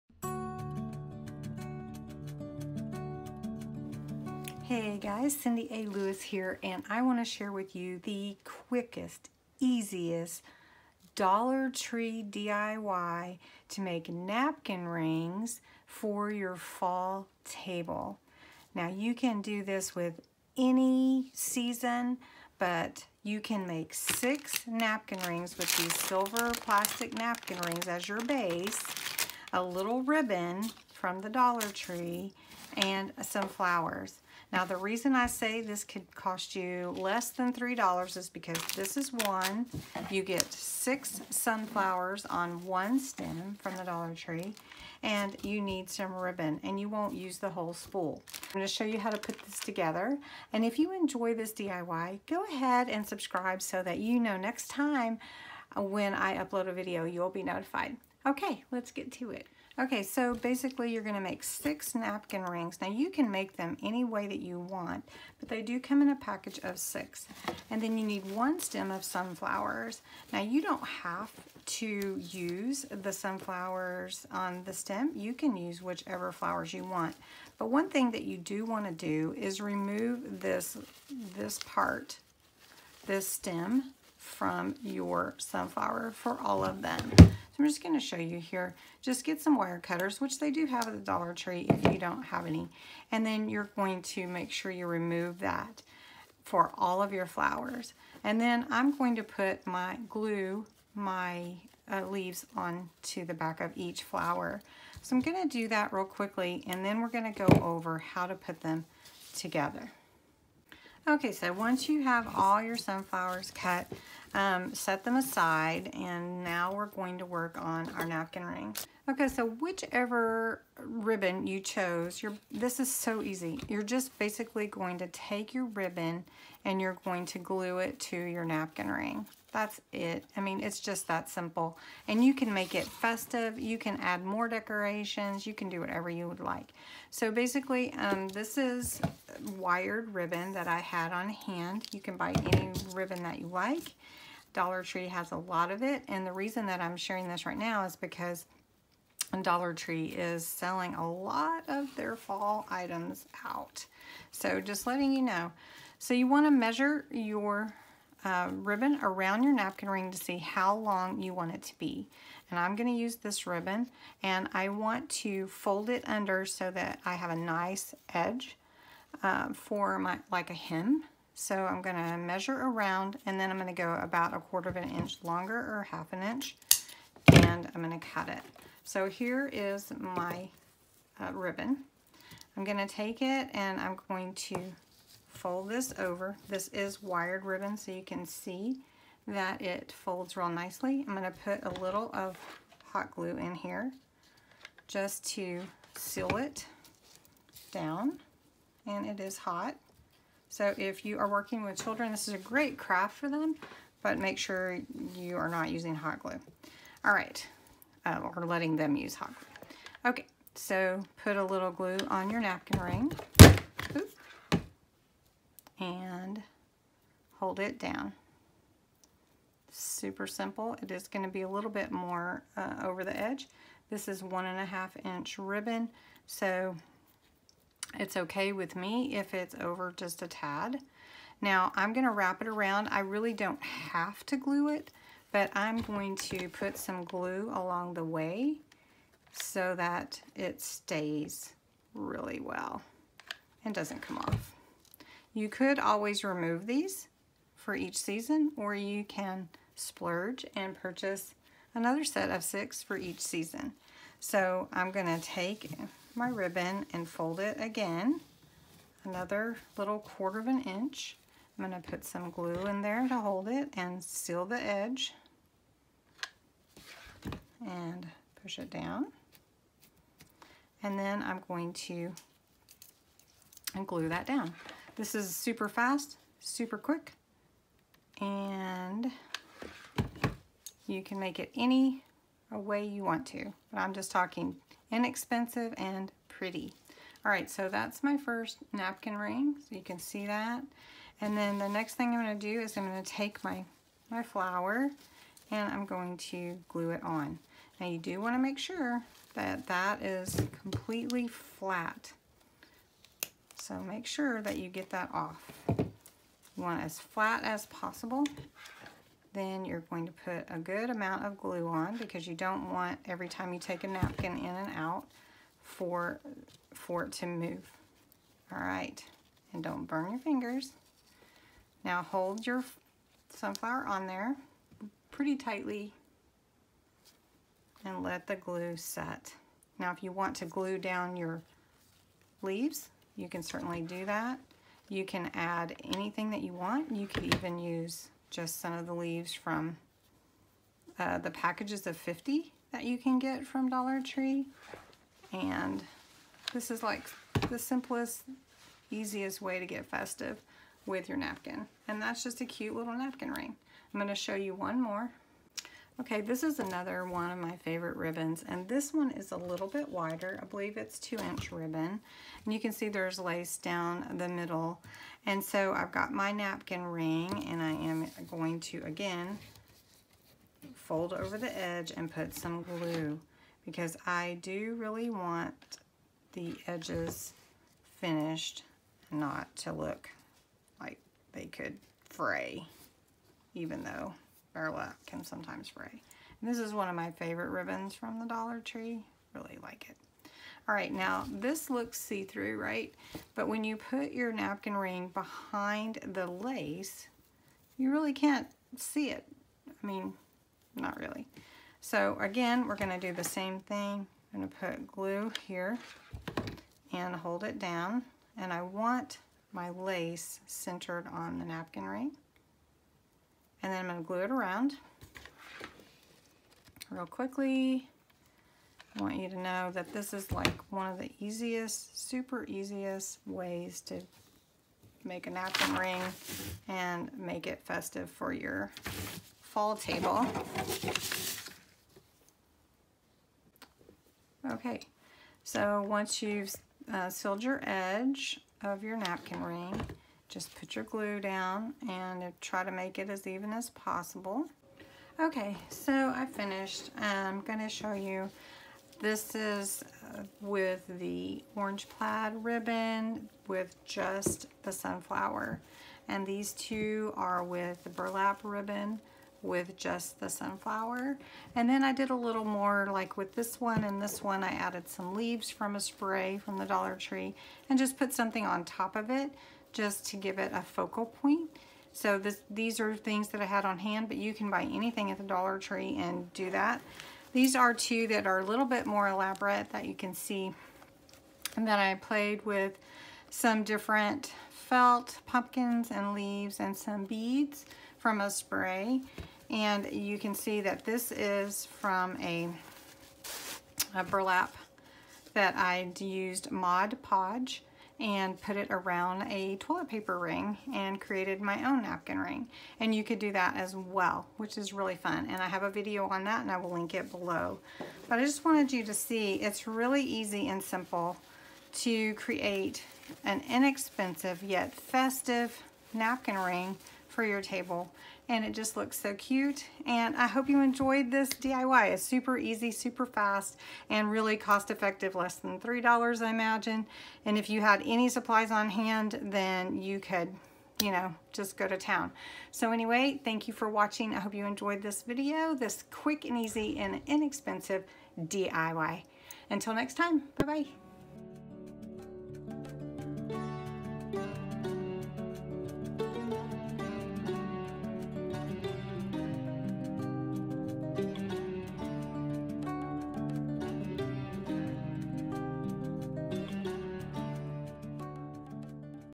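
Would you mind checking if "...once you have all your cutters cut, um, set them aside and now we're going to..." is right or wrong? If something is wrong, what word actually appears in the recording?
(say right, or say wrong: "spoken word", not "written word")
wrong: "sunflowers", not "cutters".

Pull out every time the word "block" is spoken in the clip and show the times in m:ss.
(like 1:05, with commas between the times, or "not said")
not said.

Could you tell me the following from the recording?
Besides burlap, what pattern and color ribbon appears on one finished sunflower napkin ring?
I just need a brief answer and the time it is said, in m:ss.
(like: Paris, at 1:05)
Orange plaid, at 7:31.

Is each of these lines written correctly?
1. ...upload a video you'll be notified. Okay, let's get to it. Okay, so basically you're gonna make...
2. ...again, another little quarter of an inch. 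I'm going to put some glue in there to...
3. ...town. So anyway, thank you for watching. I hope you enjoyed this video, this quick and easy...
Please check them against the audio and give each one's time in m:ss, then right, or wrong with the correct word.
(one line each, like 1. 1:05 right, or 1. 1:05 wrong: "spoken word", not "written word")
1. 0:56 right
2. 4:17 right
3. 8:51 right.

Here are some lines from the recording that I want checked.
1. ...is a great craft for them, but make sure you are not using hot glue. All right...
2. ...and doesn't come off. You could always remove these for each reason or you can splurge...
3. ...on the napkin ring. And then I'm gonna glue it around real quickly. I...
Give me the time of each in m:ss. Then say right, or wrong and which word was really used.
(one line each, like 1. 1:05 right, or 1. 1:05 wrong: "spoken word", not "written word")
1. 3:22 right
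2. 4:03 wrong: "season", not "reason"
3. 6:51 right.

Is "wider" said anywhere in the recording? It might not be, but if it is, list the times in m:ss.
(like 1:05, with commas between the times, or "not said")
5:59.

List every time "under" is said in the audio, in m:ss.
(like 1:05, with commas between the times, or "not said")
2:46.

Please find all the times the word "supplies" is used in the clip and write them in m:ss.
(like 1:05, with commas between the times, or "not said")
8:48.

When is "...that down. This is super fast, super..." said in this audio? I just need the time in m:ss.
4:34.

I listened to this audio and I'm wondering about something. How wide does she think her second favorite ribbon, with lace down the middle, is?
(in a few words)
2 inches.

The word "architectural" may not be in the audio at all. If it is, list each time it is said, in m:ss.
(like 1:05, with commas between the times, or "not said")
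not said.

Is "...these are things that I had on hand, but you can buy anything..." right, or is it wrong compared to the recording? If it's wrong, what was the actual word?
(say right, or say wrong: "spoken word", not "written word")
right.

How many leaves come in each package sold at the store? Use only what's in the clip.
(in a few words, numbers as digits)
50.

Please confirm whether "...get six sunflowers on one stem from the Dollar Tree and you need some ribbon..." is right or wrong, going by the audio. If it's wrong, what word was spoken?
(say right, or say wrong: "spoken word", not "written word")
right.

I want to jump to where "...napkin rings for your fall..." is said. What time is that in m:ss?
0:14.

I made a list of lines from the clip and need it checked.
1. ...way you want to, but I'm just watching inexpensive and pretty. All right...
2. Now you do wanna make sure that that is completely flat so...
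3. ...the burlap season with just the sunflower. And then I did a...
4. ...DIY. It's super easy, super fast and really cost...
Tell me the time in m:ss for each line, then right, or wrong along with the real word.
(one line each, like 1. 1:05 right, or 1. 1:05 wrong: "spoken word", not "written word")
1. 4:42 wrong: "talking", not "watching"
2. 4:57 right
3. 7:37 wrong: "ribbon", not "season"
4. 8:41 right.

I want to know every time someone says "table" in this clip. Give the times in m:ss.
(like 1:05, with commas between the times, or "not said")
0:17, 7:09, 8:37.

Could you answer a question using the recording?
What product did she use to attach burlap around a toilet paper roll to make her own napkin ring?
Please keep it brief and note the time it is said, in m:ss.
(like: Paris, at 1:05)
Mod Podge, at 8:16.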